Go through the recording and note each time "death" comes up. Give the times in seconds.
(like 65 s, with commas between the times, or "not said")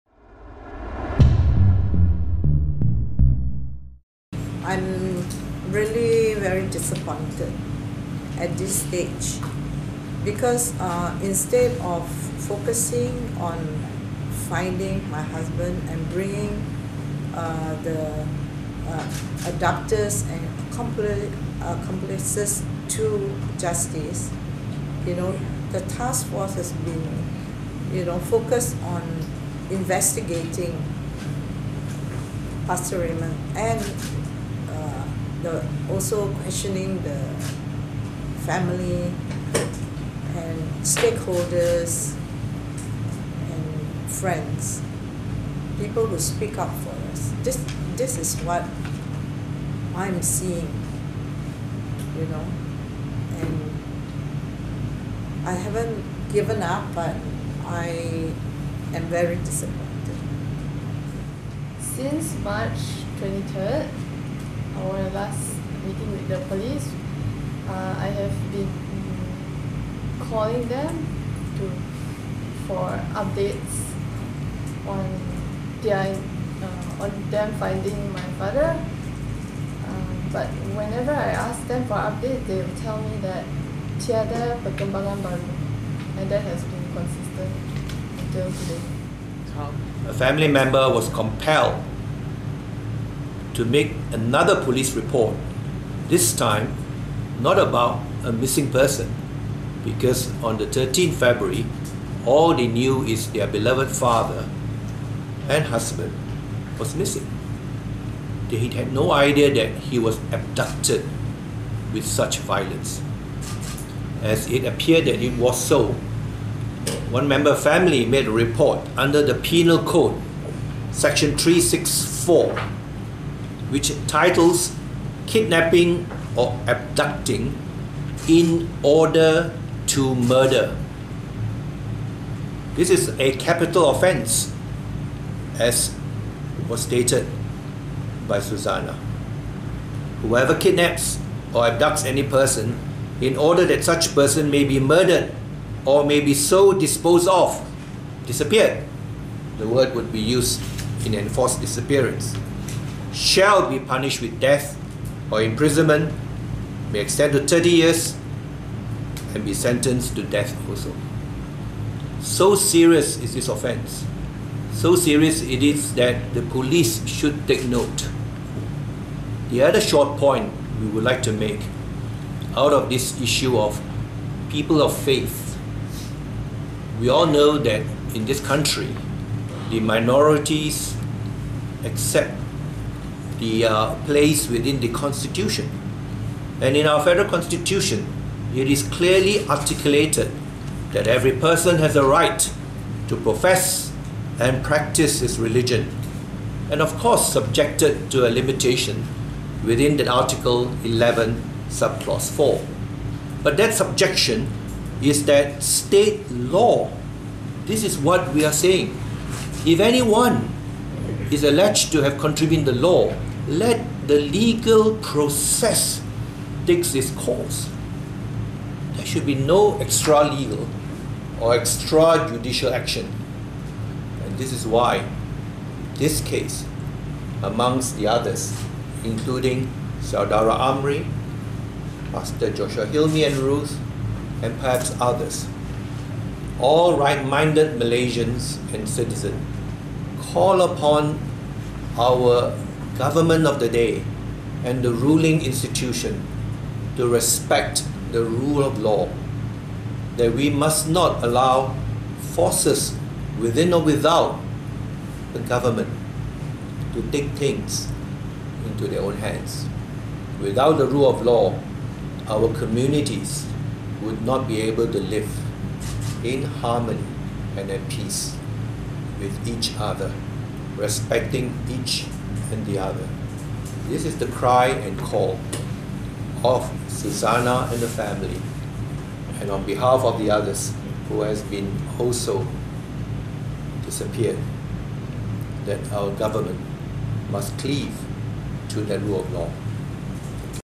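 154 s, 160 s.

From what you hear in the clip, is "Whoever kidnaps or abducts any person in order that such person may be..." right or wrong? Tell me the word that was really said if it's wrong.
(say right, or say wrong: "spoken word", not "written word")
right.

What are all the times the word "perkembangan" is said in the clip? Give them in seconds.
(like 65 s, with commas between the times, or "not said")
84 s.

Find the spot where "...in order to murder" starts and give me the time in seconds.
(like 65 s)
128 s.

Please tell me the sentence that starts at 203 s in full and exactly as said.
But that subjection is that state law.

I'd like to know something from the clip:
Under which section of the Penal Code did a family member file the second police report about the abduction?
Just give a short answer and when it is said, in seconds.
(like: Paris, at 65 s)
Section 364, at 120 s.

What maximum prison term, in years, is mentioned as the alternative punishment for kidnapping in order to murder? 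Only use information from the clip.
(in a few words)
30 years.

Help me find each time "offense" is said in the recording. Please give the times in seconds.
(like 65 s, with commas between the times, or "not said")
133 s, 163 s.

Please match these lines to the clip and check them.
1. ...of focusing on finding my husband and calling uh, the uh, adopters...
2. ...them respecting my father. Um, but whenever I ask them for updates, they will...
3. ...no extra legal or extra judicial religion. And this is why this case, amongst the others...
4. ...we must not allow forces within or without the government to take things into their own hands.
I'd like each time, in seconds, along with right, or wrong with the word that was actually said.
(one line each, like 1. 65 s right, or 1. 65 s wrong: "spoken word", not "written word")
1. 11 s wrong: "bringing", not "calling"
2. 77 s wrong: "finding", not "respecting"
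3. 219 s wrong: "action", not "religion"
4. 250 s right.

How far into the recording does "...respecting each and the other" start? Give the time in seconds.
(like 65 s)
270 s.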